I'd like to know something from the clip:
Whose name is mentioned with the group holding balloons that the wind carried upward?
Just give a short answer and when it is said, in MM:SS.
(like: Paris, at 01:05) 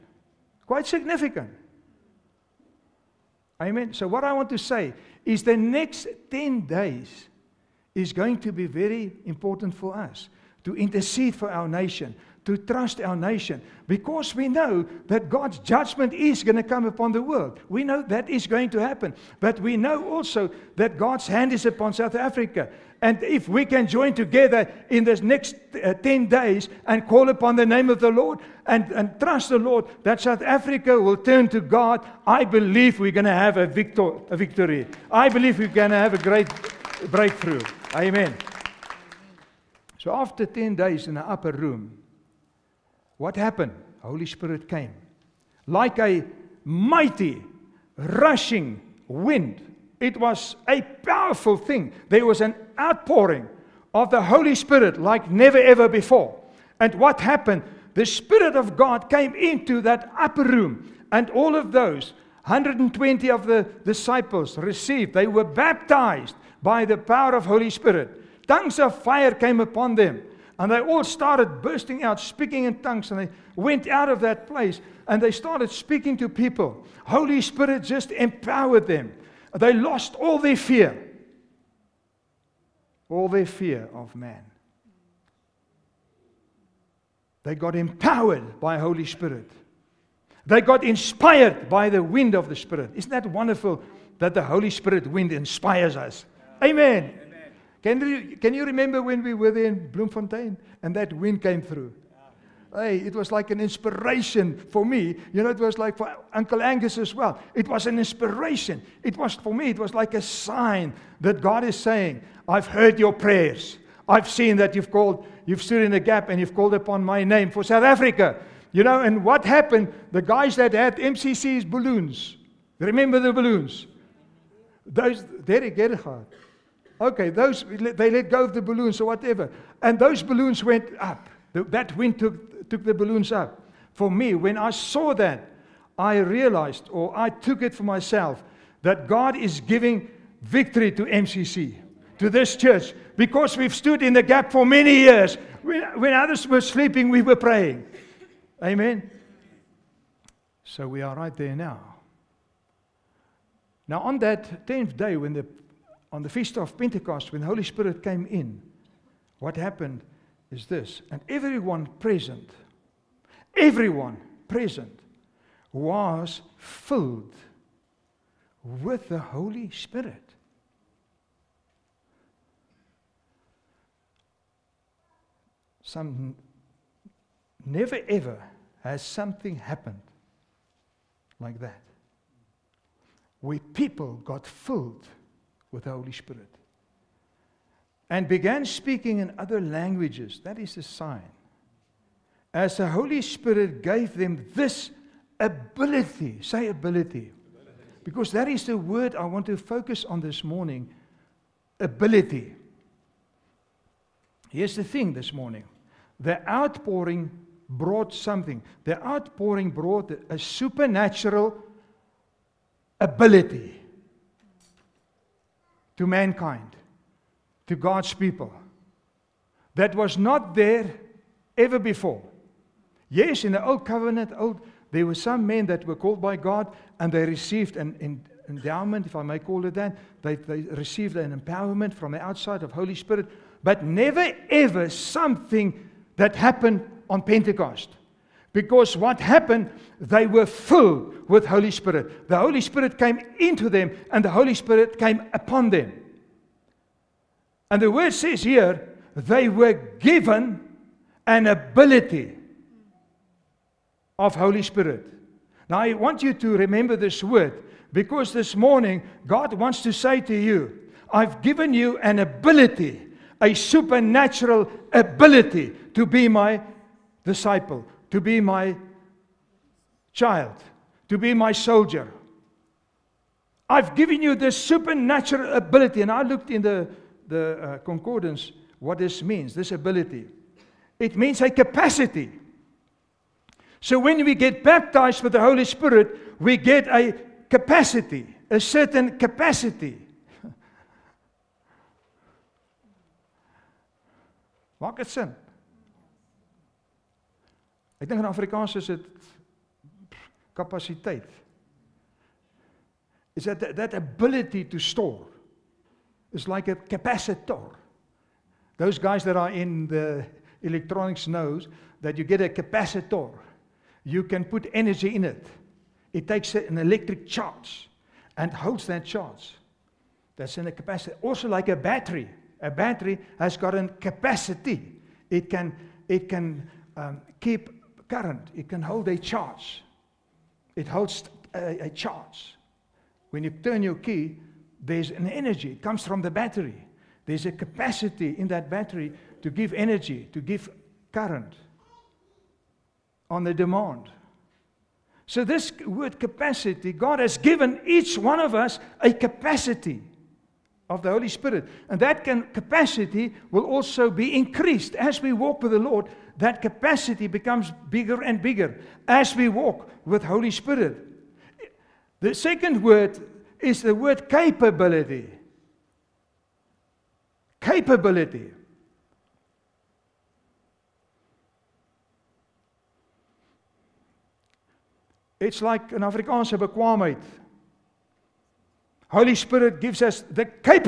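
Derek Gerhardt, at 02:05.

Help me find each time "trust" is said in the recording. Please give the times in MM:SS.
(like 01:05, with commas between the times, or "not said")
00:12, 00:29.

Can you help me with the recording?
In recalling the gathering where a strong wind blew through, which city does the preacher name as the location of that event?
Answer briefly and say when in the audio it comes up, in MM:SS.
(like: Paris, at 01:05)
Bloemfontein, at 01:39.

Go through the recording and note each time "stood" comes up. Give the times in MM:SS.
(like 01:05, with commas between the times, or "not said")
01:55, 02:23.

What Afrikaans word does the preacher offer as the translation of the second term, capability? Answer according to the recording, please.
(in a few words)
bekwaamheid.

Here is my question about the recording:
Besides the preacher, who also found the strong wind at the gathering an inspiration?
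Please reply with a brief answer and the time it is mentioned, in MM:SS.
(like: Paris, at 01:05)
Uncle Angus, at 01:46.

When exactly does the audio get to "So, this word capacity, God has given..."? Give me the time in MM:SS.
05:45.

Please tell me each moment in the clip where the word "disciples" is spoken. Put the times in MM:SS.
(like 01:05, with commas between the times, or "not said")
01:03, 04:27.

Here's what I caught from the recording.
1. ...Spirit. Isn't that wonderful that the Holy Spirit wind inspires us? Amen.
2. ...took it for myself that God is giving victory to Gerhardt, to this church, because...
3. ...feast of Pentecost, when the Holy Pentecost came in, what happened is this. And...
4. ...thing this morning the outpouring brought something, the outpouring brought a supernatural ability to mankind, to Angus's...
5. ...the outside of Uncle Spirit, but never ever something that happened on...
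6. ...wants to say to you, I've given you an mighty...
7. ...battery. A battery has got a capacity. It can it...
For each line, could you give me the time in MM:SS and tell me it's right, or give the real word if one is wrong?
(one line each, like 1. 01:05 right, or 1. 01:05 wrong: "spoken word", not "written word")
1. 01:32 right
2. 02:17 wrong: "MCC", not "Gerhardt"
3. 02:36 wrong: "Spirit", not "Pentecost"
4. 03:24 wrong: "God", not "Angus"
5. 03:52 wrong: "Holy", not "Uncle"
6. 04:19 wrong: "ability", not "mighty"
7. 05:21 right.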